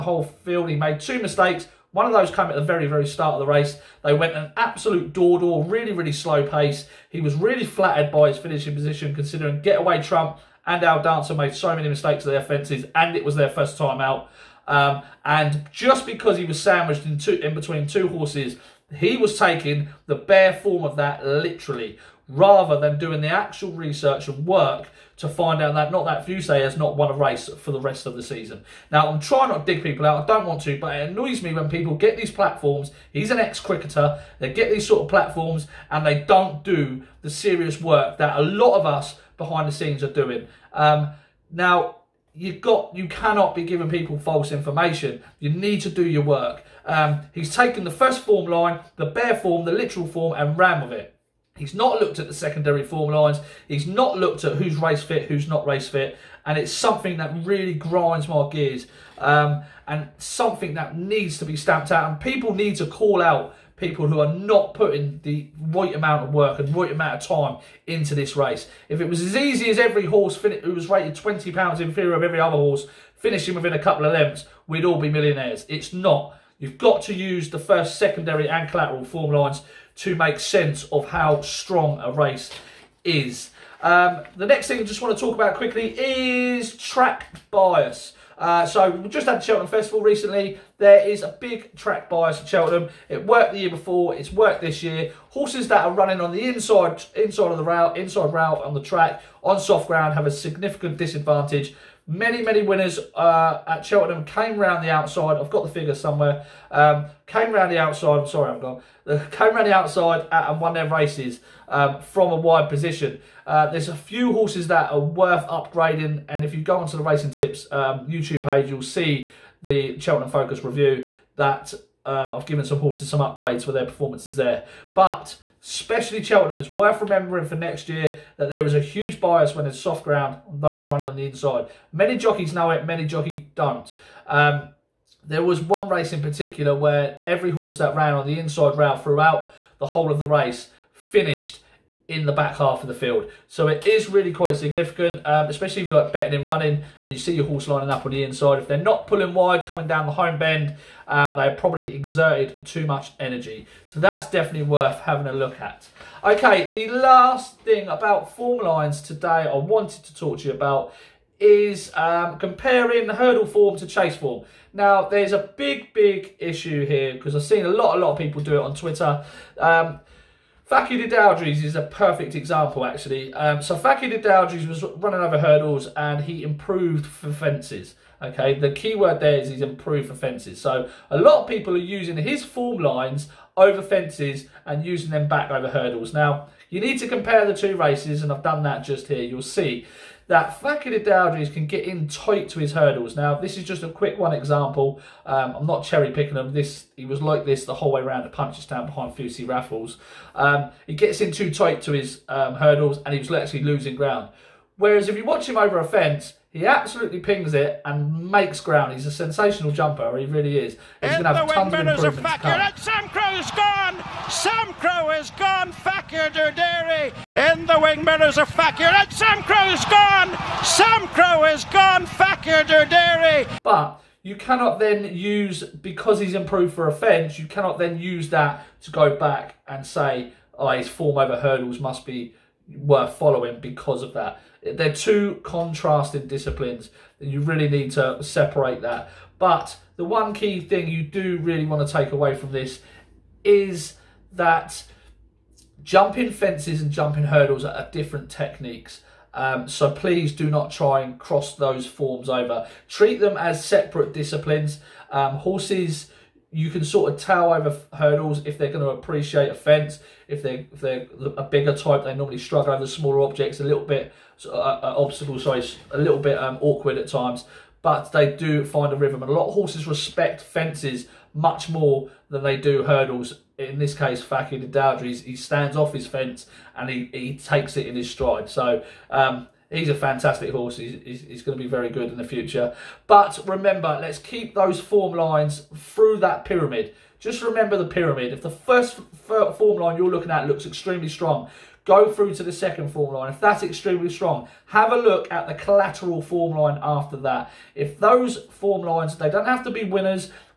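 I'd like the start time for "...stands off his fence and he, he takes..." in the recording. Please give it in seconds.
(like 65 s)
275 s.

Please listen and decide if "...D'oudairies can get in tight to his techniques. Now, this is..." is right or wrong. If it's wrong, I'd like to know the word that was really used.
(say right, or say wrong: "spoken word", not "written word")
wrong: "hurdles", not "techniques".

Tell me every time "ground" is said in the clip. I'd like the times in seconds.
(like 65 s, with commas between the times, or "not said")
99 s, 130 s, 203 s, 208 s.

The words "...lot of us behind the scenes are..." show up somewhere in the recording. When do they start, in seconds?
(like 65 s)
38 s.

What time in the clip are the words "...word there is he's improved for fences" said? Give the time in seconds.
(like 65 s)
178 s.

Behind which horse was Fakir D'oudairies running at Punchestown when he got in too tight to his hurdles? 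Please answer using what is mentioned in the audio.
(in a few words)
Fusil Raffles.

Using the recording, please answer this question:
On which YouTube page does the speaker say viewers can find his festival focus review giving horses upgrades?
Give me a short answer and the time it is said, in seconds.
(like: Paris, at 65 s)
Racing Tips, at 117 s.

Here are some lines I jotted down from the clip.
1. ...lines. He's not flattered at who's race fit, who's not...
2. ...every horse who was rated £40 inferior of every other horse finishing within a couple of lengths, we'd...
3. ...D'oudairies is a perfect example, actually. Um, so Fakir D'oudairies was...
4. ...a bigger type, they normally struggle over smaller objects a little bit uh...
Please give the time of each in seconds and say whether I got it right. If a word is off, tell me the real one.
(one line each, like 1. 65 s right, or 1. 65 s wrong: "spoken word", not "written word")
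1. 53 s wrong: "looked", not "flattered"
2. 69 s wrong: "20", not "40"
3. 171 s right
4. 261 s right.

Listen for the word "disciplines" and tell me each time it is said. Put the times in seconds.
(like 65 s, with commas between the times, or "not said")
236 s, 254 s.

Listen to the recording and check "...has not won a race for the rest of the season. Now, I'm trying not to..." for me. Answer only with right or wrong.
right.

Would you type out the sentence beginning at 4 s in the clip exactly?
They went an absolute door-door, really, really slow pace.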